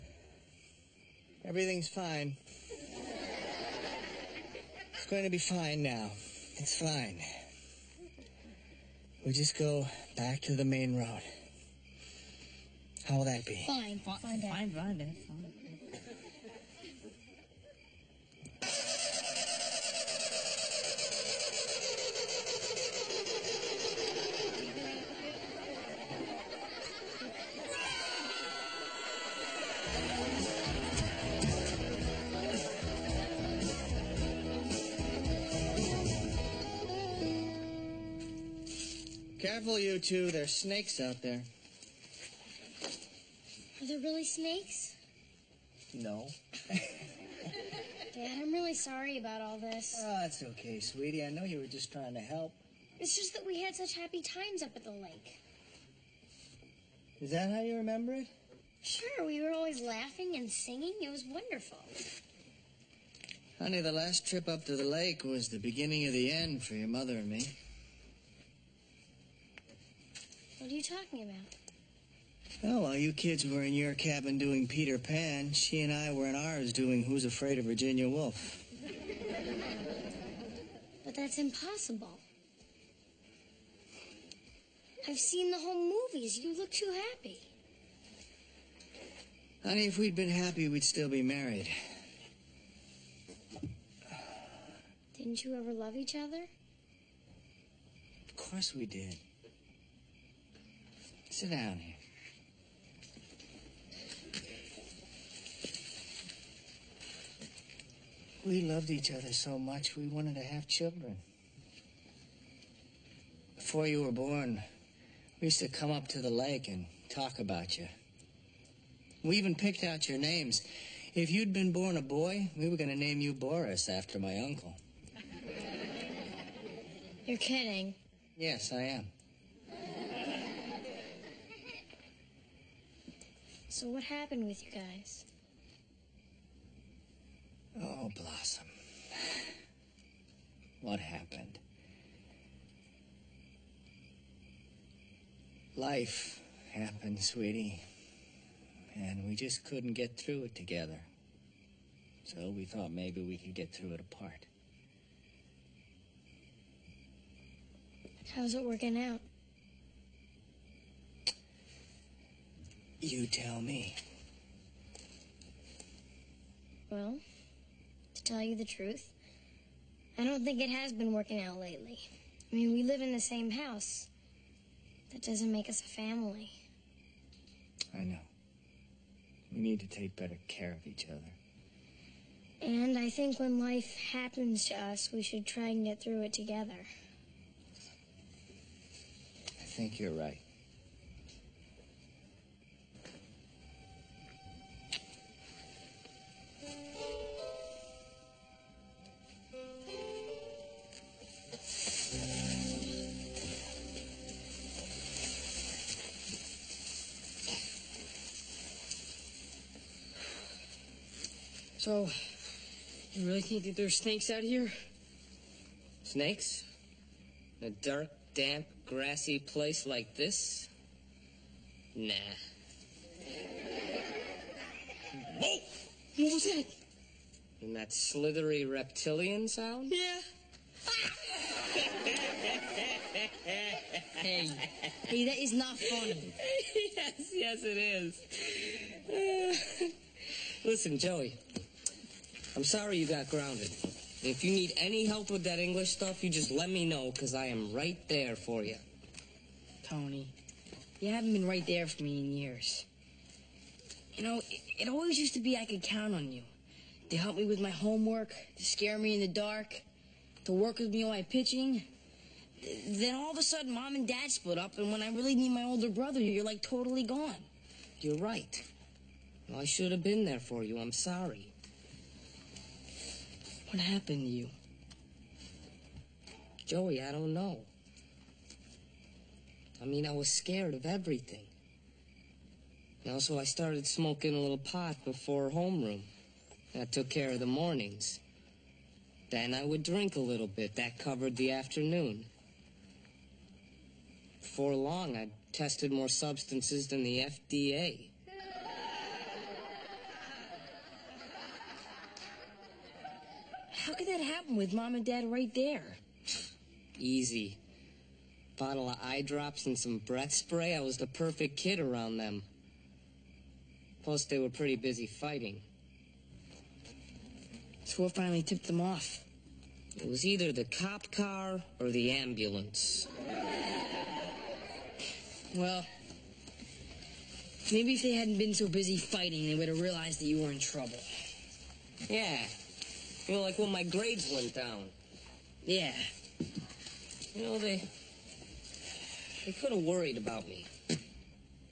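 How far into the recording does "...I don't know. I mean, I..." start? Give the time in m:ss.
4:37.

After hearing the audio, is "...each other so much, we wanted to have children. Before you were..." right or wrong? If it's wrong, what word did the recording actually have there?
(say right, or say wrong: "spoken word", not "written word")
right.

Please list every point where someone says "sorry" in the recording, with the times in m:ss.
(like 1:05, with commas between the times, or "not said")
0:48, 4:02, 4:30.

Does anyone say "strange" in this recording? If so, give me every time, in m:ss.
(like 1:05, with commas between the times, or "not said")
not said.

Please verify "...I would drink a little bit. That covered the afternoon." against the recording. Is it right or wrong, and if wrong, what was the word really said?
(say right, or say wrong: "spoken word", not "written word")
right.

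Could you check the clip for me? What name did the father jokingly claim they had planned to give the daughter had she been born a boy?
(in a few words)
Boris.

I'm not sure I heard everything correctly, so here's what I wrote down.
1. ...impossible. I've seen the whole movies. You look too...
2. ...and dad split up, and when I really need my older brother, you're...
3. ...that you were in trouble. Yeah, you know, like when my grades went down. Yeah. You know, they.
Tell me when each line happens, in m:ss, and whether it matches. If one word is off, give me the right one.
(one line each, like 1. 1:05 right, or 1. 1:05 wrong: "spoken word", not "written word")
1. 1:21 right
2. 4:23 right
3. 5:30 right.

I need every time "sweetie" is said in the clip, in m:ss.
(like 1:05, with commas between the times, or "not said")
0:50, 2:27.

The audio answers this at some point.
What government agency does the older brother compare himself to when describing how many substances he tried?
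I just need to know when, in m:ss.
4:57.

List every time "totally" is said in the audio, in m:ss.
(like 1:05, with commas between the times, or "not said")
4:26.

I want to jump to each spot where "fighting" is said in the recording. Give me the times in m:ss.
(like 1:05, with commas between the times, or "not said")
5:15, 5:28.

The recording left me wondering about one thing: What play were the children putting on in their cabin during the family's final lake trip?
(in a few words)
Peter Pan.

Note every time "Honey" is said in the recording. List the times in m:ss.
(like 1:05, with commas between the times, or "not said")
1:03, 1:29.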